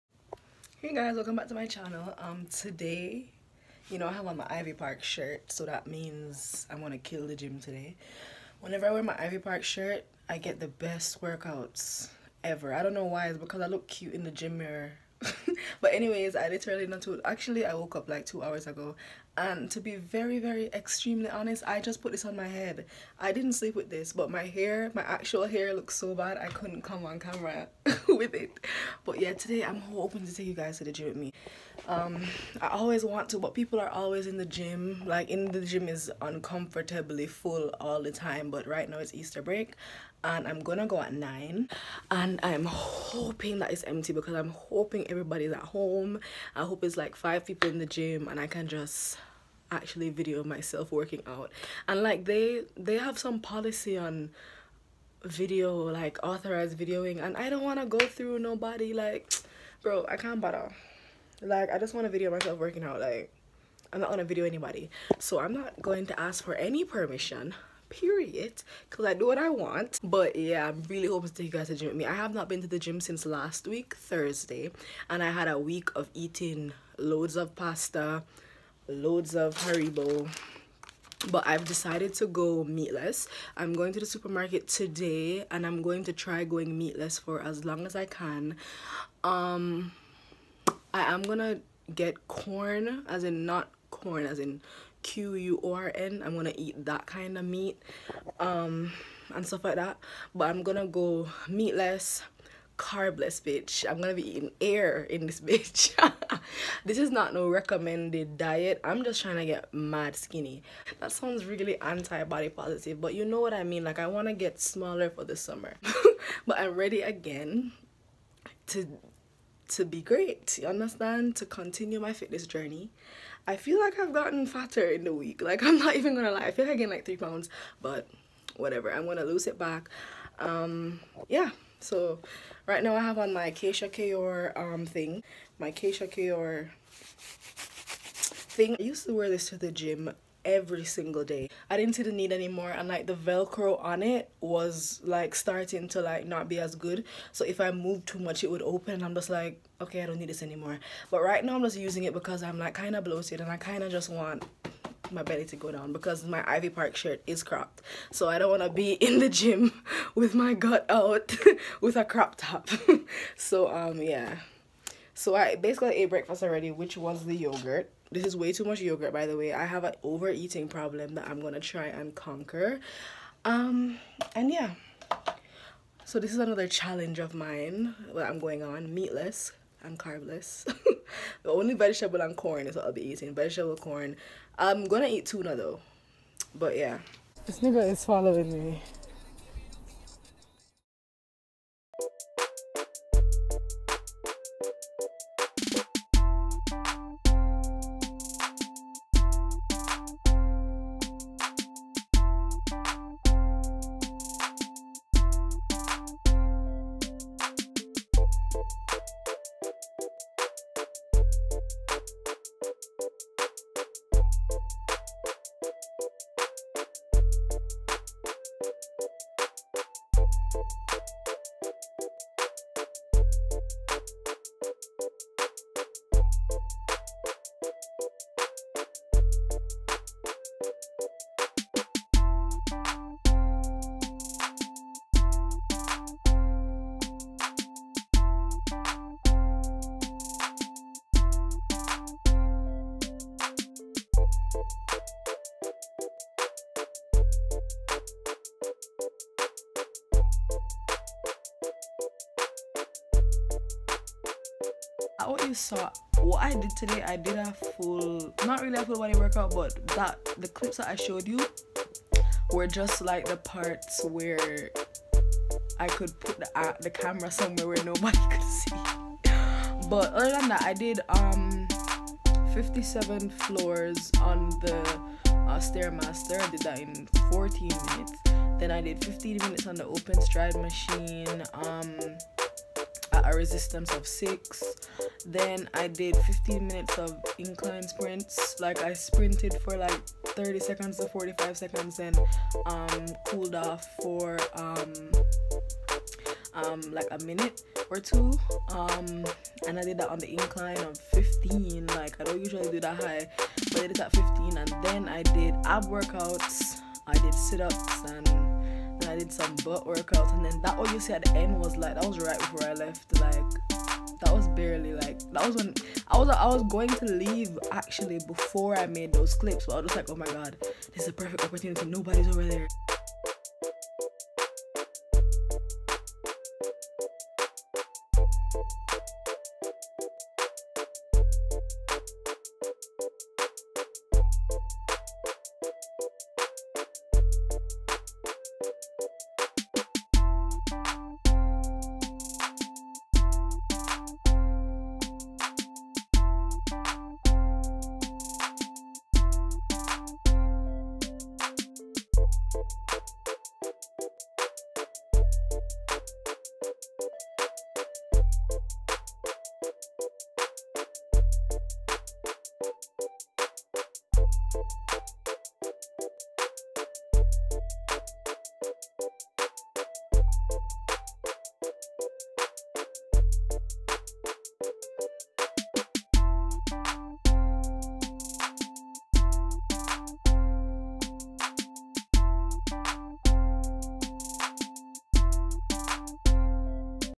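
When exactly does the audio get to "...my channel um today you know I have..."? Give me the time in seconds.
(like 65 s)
1 s.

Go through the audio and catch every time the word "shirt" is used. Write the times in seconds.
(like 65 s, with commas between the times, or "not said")
5 s, 9 s, 156 s.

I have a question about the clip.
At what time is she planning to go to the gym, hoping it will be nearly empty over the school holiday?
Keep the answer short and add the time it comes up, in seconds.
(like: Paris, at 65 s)
9, at 41 s.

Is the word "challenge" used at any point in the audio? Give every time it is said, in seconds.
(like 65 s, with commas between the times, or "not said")
176 s.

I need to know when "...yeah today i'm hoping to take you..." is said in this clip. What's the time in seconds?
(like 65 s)
29 s.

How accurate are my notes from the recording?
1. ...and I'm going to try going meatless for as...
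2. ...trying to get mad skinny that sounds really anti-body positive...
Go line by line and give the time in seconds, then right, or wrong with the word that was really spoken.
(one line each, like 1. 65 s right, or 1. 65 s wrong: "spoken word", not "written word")
1. 85 s right
2. 109 s right.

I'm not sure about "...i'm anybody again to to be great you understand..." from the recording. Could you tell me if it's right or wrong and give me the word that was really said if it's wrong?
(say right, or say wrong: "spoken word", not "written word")
wrong: "ready", not "anybody".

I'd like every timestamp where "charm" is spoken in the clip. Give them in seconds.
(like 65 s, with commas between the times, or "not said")
not said.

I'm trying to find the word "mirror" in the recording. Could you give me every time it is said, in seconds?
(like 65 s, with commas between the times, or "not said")
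14 s.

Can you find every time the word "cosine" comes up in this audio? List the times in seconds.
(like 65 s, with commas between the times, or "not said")
not said.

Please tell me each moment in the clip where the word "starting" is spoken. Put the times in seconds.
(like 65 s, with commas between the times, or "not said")
145 s.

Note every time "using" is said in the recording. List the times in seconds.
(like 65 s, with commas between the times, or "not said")
151 s.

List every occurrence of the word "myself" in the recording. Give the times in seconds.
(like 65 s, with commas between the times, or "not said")
50 s, 62 s.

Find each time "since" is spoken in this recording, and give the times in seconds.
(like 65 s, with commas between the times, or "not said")
73 s.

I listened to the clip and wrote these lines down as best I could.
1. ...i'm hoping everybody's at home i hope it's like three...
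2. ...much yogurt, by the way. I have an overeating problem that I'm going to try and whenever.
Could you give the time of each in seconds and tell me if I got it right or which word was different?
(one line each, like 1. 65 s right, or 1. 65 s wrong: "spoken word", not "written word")
1. 44 s wrong: "five", not "three"
2. 168 s wrong: "conquer", not "whenever".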